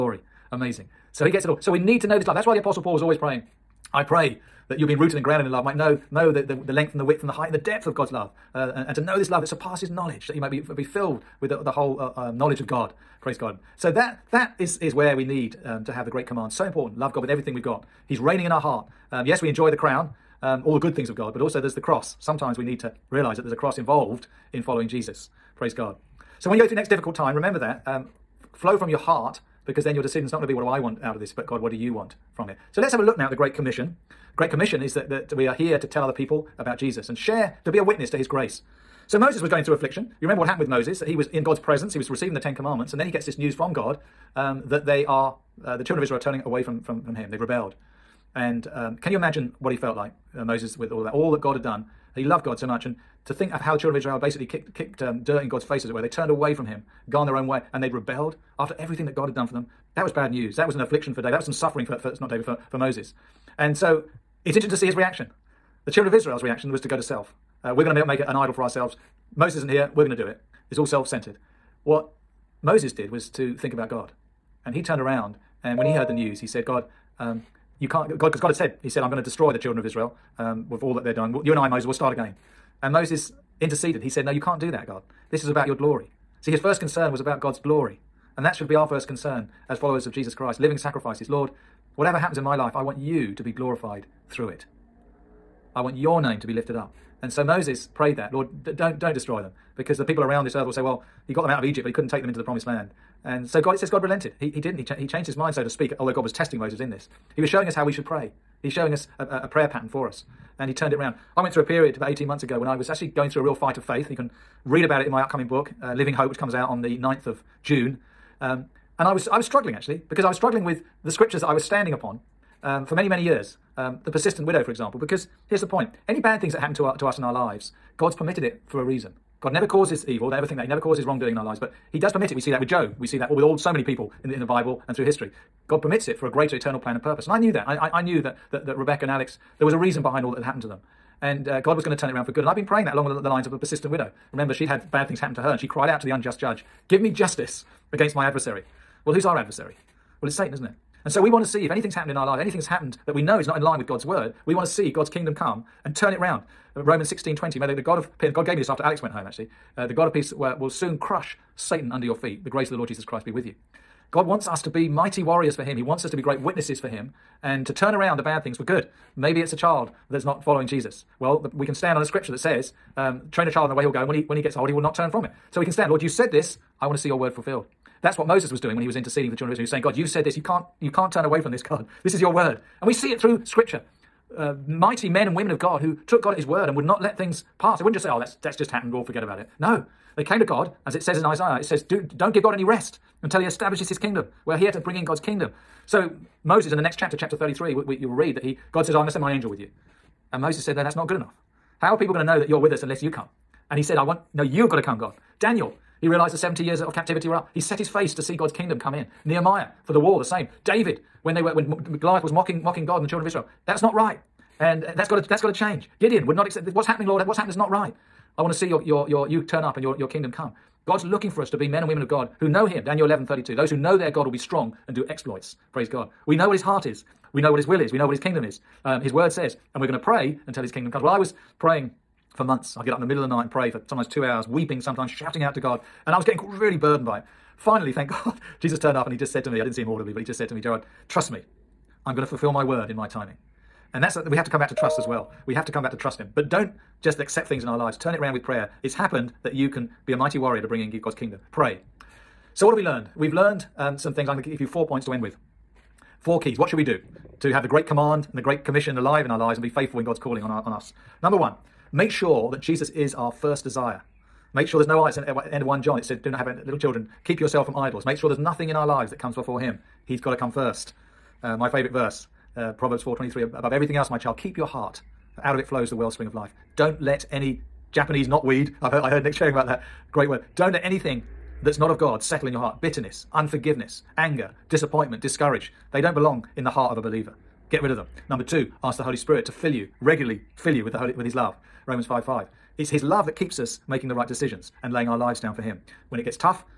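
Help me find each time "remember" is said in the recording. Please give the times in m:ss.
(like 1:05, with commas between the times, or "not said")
0:27, 0:40, 2:24.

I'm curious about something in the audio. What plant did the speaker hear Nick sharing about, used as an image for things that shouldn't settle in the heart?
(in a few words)
Japanese knotweed.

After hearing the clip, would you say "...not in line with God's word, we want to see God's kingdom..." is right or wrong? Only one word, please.
right.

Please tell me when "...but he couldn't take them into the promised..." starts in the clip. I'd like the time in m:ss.
1:41.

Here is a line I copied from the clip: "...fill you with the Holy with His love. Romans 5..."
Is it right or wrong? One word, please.
right.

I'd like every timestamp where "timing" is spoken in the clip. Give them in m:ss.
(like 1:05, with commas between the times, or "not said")
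4:03.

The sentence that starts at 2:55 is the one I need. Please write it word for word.
So we can stand, Lord, you said this, I want to see your word fulfilled.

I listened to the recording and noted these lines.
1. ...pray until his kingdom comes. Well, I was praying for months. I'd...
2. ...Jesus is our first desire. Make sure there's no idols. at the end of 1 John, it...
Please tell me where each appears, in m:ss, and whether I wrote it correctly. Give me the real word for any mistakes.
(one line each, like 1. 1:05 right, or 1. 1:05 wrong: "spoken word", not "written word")
1. 3:49 right
2. 4:22 right.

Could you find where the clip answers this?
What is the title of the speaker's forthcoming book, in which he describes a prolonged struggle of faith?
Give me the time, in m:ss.
1:55.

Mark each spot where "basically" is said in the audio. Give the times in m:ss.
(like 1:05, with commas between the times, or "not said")
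0:54.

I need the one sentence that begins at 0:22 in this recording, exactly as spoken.
Sometimes we need to realize that there's a cross involved in following Jesus.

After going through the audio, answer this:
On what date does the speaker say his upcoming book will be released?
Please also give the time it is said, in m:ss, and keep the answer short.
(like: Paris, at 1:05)
9th of June, at 1:56.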